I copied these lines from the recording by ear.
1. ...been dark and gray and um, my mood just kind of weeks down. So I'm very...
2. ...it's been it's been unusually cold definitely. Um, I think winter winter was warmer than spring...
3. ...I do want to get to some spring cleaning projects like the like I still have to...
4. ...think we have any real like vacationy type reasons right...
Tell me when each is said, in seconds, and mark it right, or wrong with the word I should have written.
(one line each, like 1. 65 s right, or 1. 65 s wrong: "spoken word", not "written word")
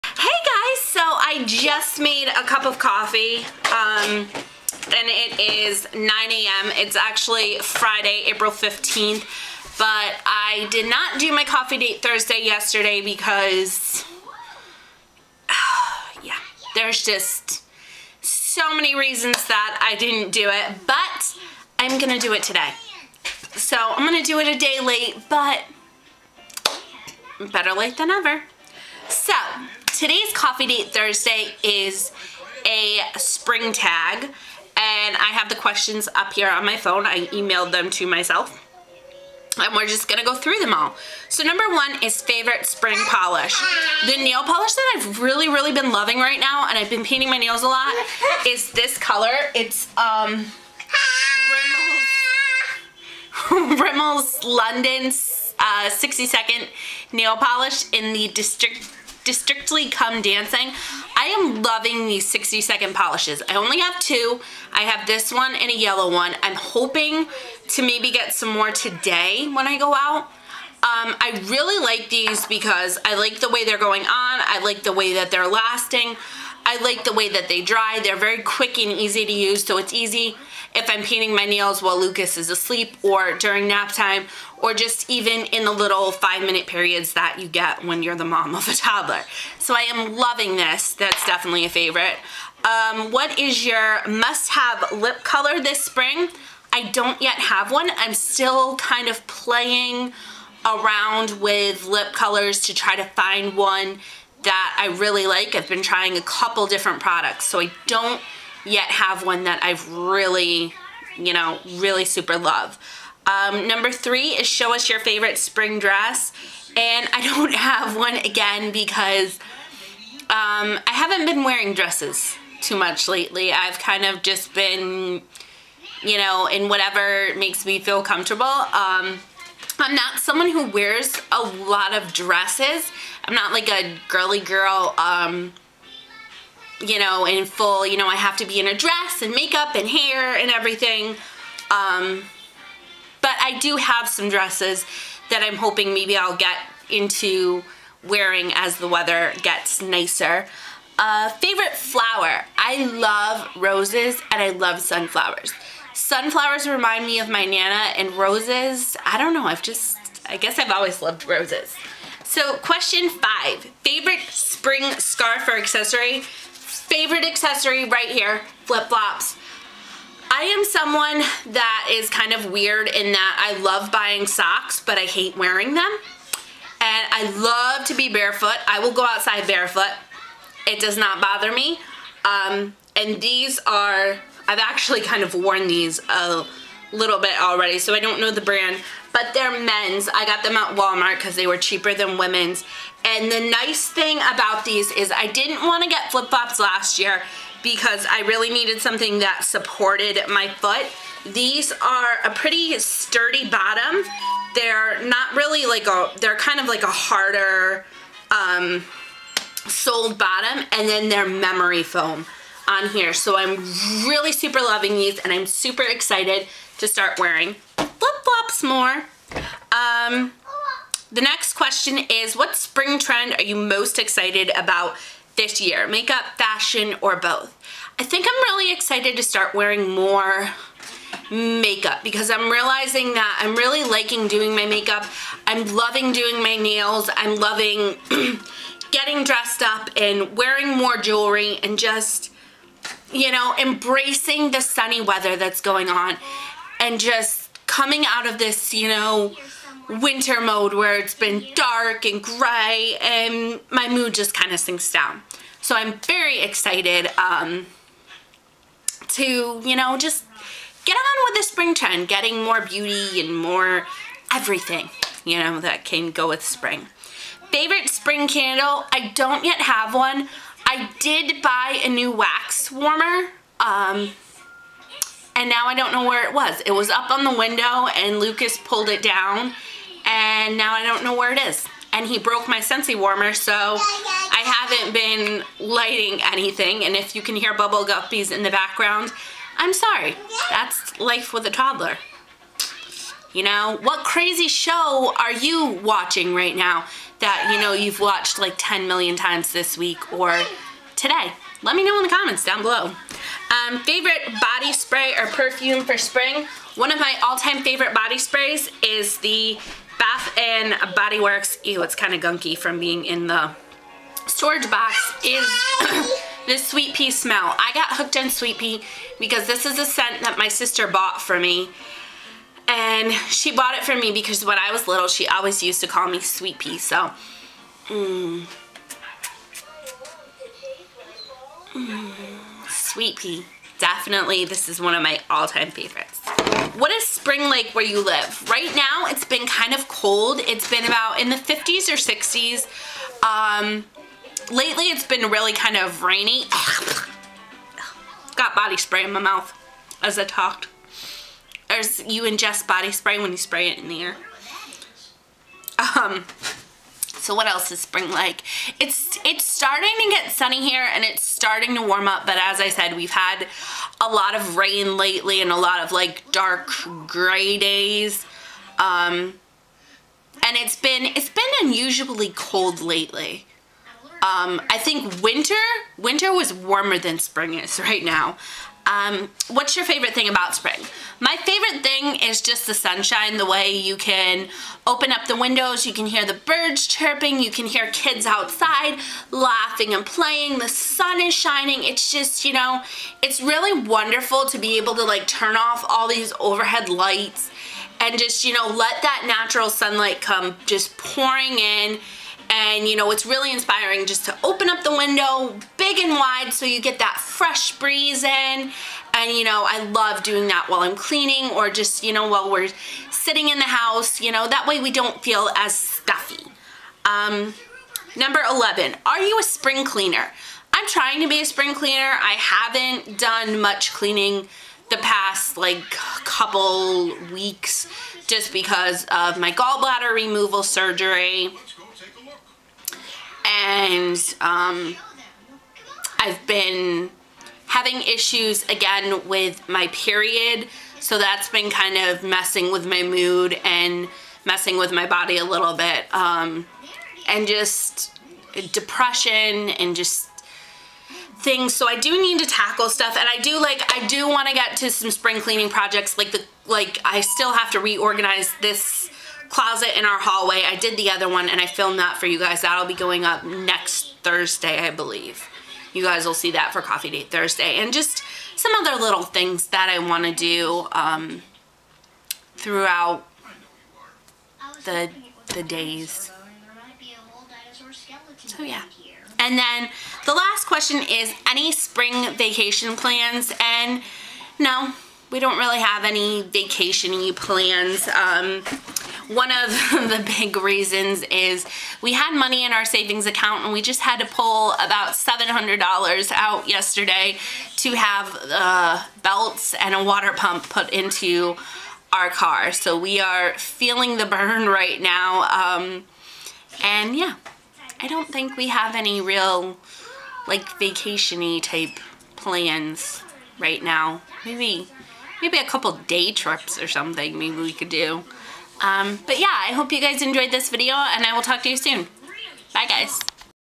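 1. 251 s wrong: "sinks", not "weeks"
2. 370 s wrong: "lately", not "definitely"
3. 453 s right
4. 508 s wrong: "plans", not "reasons".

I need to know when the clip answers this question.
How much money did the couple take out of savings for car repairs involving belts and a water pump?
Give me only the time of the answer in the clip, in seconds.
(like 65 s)
495 s.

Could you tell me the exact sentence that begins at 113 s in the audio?
Um, number three is show us your favorite spring dress.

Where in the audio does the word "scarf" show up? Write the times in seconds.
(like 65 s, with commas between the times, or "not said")
164 s.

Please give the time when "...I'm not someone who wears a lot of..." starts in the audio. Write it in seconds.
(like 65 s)
129 s.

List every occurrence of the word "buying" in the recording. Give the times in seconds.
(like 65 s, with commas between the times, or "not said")
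173 s.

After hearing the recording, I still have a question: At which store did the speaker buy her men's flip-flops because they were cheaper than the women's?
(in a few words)
Walmart.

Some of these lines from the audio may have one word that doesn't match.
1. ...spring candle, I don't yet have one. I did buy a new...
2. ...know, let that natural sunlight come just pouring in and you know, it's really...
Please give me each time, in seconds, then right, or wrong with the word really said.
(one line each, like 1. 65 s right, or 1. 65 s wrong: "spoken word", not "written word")
1. 267 s right
2. 398 s right.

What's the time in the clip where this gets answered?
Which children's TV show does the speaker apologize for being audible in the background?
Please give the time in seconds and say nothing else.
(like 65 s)
287 s.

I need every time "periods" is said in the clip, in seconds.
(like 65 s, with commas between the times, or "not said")
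86 s, 439 s.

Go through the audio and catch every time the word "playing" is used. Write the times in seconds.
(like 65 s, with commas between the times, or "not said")
99 s, 390 s.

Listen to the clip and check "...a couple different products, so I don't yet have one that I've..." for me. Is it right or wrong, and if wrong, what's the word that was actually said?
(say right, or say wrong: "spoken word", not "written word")
right.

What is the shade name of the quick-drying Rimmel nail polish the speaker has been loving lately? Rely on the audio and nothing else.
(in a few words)
Districtly Come Dancing.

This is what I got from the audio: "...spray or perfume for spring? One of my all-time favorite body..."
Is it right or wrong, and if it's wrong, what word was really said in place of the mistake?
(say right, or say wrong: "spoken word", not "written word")
right.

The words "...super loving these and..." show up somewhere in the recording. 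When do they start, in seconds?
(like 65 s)
214 s.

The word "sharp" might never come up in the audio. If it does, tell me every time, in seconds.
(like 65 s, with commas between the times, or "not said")
not said.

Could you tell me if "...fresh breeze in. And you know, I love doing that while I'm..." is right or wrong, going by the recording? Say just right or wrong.
right.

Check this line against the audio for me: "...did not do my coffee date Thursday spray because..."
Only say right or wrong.
wrong.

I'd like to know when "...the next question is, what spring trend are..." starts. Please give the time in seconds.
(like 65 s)
221 s.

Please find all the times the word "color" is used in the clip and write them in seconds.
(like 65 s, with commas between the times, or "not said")
48 s, 95 s, 102 s.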